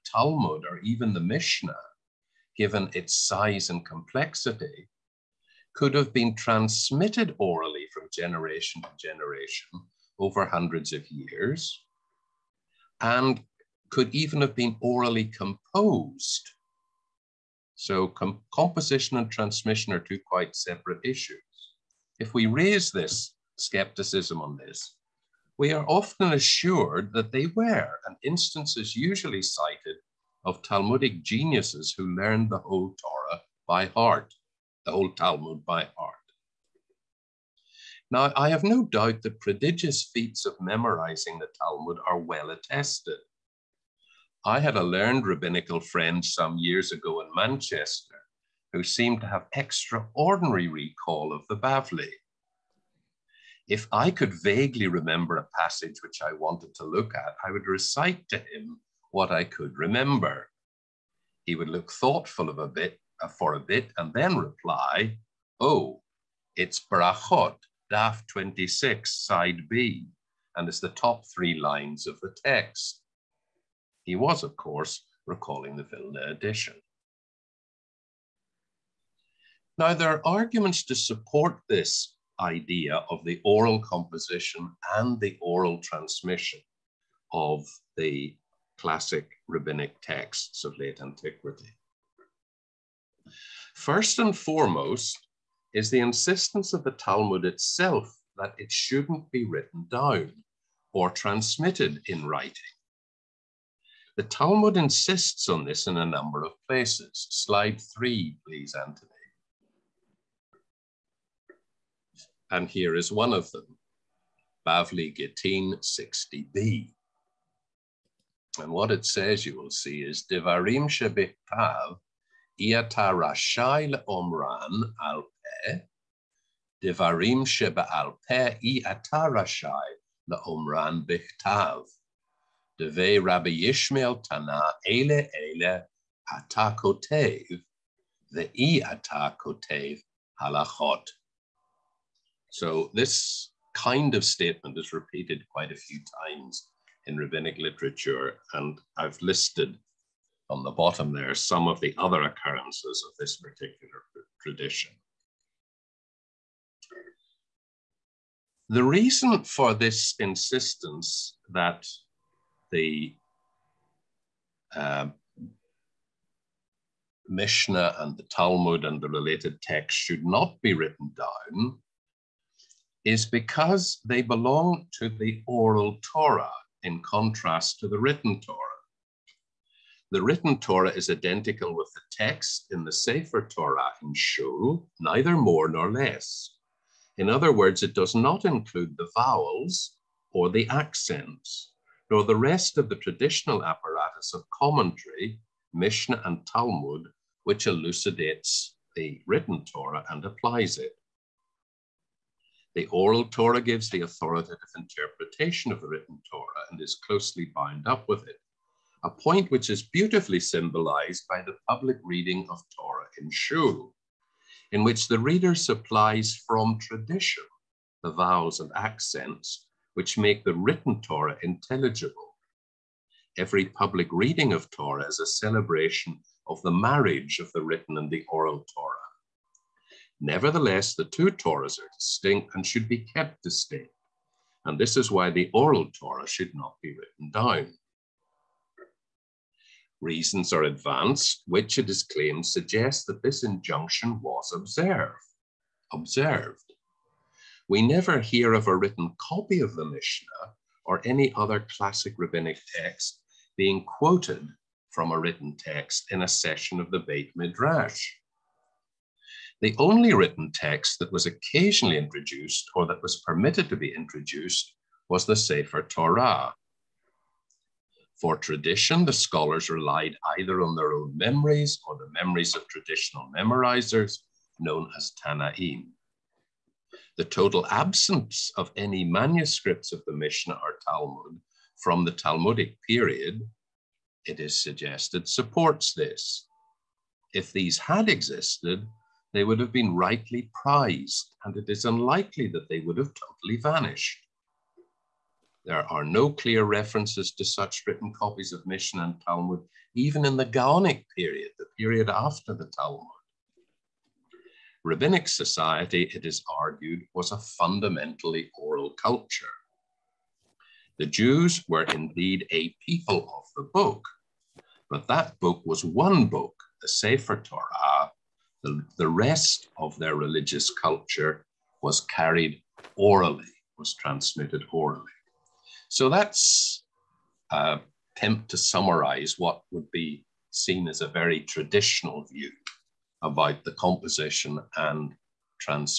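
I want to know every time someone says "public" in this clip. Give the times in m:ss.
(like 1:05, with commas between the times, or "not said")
3:31, 3:43.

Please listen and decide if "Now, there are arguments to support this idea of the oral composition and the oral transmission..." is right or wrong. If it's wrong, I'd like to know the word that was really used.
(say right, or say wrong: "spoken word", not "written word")
right.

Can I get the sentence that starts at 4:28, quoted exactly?
For tradition, the scholars relied either on their own memories or the memories of traditional memorizers, known as Tannaim.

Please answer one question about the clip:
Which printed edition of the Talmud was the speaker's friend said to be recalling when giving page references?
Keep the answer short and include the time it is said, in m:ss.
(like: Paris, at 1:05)
Vilna edition, at 1:15.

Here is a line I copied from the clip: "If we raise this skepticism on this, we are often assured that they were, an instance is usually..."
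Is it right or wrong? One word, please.
right.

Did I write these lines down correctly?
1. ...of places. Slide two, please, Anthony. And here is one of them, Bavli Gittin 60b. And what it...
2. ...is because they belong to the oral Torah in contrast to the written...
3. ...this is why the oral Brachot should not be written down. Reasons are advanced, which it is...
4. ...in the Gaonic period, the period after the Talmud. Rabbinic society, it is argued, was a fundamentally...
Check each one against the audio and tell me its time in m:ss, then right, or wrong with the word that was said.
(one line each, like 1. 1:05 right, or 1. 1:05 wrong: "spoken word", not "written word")
1. 1:46 wrong: "three", not "two"
2. 2:53 right
3. 3:54 wrong: "Torah", not "Brachot"
4. 5:00 right.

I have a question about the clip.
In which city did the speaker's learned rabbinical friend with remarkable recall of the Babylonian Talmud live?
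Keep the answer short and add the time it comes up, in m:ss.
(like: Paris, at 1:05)
Manchester, at 0:47.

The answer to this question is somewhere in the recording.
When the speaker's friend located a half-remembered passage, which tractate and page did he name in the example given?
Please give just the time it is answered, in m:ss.
1:06.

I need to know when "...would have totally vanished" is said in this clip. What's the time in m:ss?
4:52.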